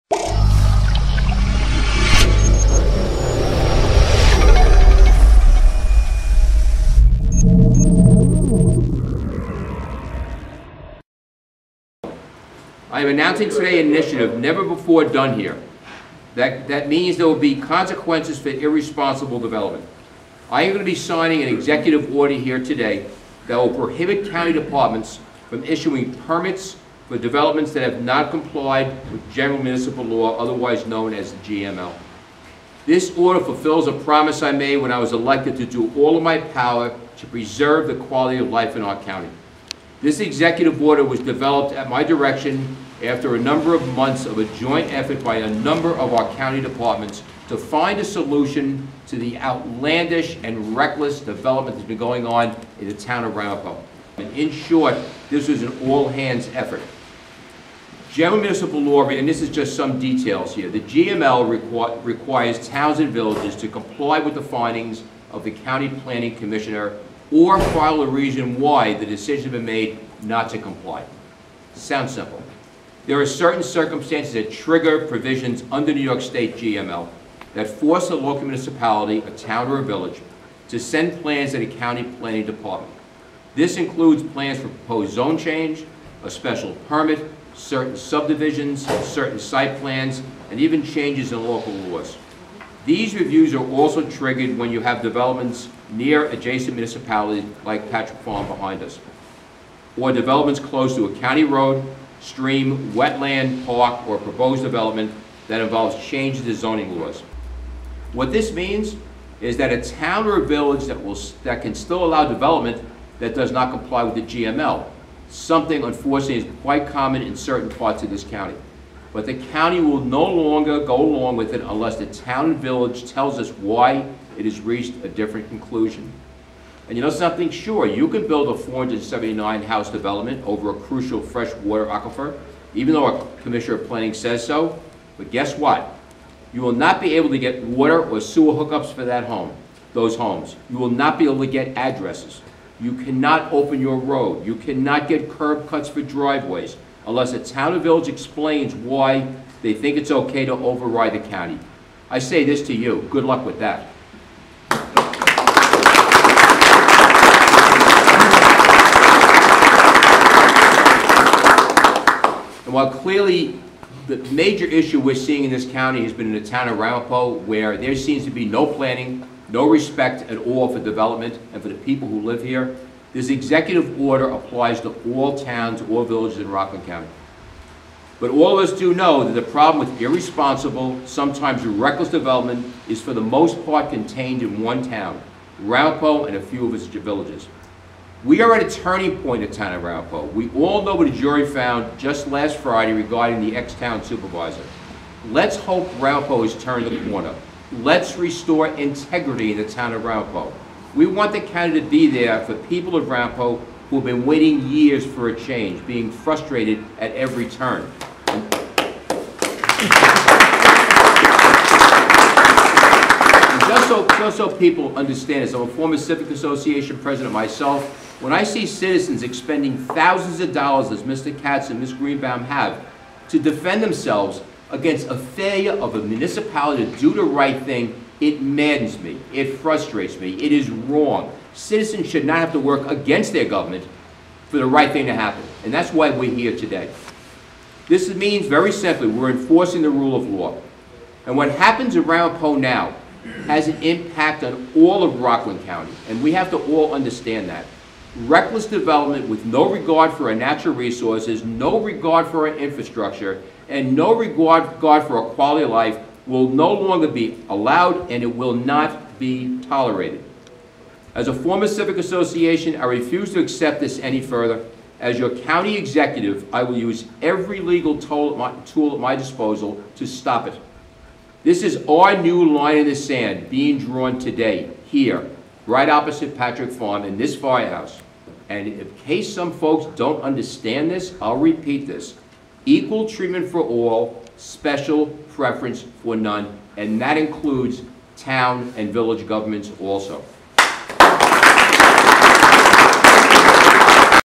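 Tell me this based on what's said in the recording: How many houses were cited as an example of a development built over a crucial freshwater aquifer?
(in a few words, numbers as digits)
479.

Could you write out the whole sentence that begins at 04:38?
And in case some folks don't understand this, I'll repeat this.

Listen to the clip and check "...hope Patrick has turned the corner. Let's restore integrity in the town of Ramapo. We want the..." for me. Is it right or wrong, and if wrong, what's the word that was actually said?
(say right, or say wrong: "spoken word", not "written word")
wrong: "Ramapo", not "Patrick".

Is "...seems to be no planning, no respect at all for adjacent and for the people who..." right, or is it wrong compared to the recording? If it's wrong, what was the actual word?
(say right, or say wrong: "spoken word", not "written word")
wrong: "development", not "adjacent".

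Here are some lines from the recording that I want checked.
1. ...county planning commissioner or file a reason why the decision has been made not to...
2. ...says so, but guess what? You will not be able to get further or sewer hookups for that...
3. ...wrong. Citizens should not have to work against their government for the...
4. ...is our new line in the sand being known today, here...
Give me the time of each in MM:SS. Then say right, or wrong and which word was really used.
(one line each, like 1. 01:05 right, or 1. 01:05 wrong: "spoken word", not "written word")
1. 01:05 right
2. 02:14 wrong: "water", not "further"
3. 03:50 right
4. 04:31 wrong: "drawn", not "known".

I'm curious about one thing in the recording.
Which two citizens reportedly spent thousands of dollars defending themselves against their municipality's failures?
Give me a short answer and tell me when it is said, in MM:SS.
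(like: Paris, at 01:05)
Mr. Katz and Ms. Greenbaum, at 03:41.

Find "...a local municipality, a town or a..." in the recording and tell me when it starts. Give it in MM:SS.
01:18.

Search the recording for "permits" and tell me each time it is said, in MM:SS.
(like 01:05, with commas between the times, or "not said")
00:26, 01:26.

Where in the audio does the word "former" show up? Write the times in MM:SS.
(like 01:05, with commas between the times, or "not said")
03:35, 04:21.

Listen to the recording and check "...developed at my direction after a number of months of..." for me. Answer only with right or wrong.
right.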